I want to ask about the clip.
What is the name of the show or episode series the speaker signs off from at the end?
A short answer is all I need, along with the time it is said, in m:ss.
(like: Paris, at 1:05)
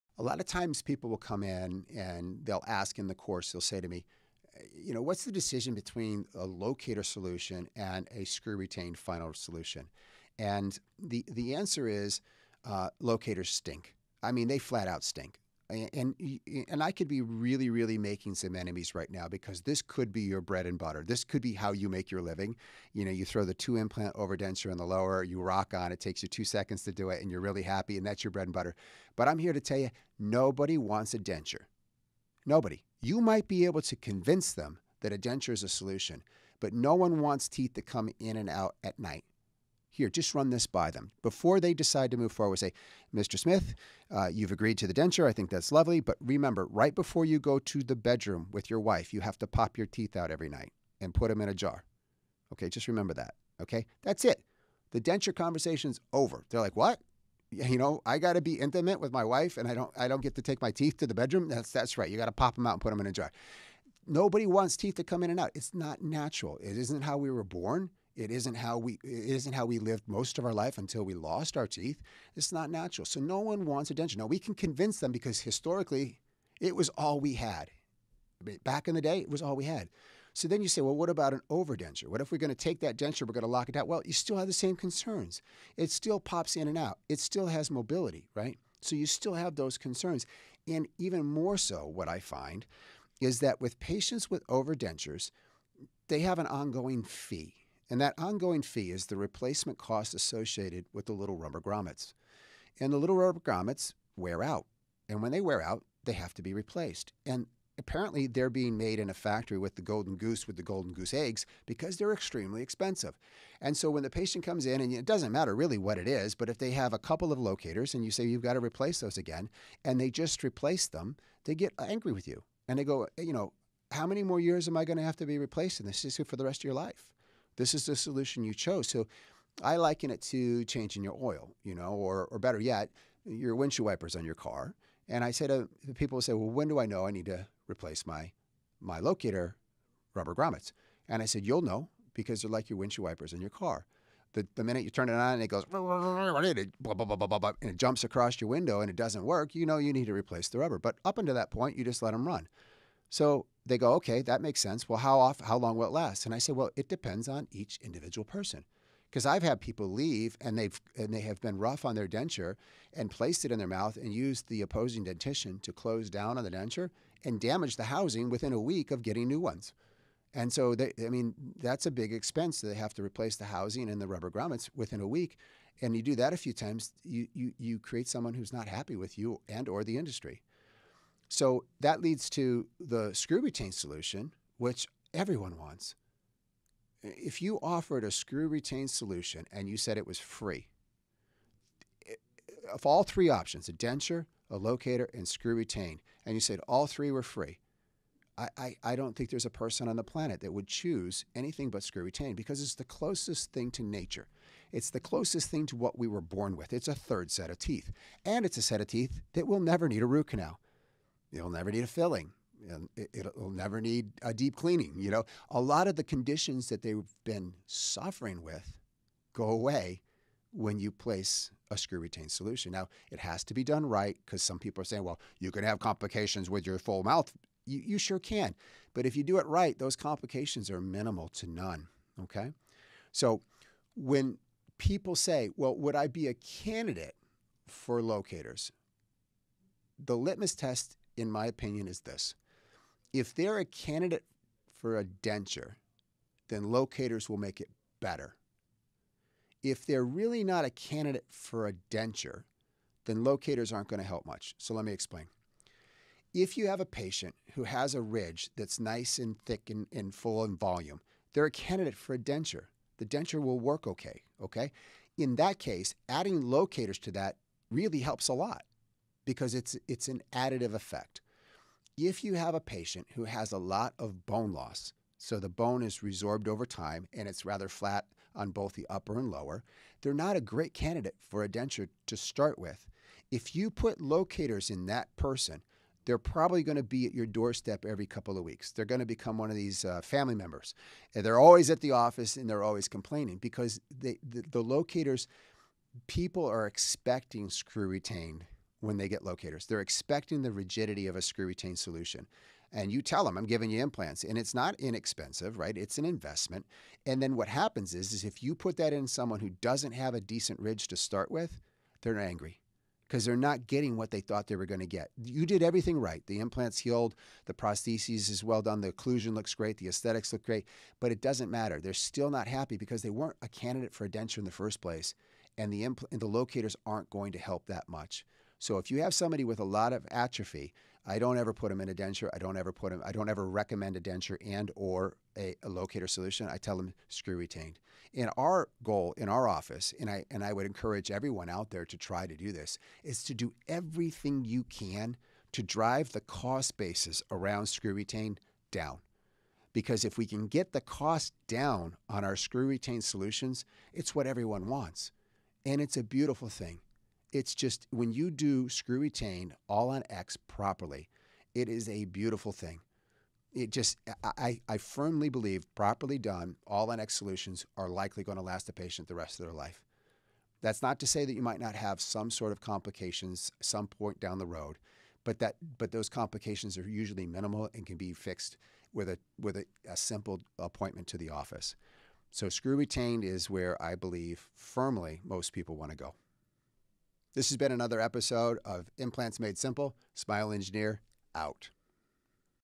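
Implants Made Simple, at 6:28.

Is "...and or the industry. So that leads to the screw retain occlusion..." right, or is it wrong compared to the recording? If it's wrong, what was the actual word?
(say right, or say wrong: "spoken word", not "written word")
wrong: "solution", not "occlusion".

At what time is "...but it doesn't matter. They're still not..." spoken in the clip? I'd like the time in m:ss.
5:21.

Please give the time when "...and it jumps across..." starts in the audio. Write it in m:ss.
2:25.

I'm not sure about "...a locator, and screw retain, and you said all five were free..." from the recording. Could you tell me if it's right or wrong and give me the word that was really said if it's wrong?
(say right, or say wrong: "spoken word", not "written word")
wrong: "three", not "five".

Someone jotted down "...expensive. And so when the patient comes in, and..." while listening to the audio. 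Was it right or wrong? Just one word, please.
right.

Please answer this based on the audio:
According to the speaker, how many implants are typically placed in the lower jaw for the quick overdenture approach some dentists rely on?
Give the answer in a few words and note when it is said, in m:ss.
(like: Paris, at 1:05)
2, at 0:23.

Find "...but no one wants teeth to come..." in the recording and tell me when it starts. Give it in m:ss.
0:36.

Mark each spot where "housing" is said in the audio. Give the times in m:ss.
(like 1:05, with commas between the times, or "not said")
2:47, 2:53.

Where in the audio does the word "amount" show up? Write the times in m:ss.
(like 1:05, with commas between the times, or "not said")
not said.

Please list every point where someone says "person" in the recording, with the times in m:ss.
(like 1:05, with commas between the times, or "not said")
2:38, 3:19, 4:45.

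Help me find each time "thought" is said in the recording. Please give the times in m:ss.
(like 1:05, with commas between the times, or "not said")
5:14.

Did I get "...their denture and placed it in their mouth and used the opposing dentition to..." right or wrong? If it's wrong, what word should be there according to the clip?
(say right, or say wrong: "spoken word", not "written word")
right.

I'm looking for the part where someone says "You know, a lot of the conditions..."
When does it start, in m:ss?
3:34.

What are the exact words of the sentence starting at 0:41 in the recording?
Before they decide to move forward, say, Mr.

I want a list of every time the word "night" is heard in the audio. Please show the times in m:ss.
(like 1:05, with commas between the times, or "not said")
0:38, 0:50.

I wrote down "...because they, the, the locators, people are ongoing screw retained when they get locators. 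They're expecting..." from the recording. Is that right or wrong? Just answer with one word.
wrong.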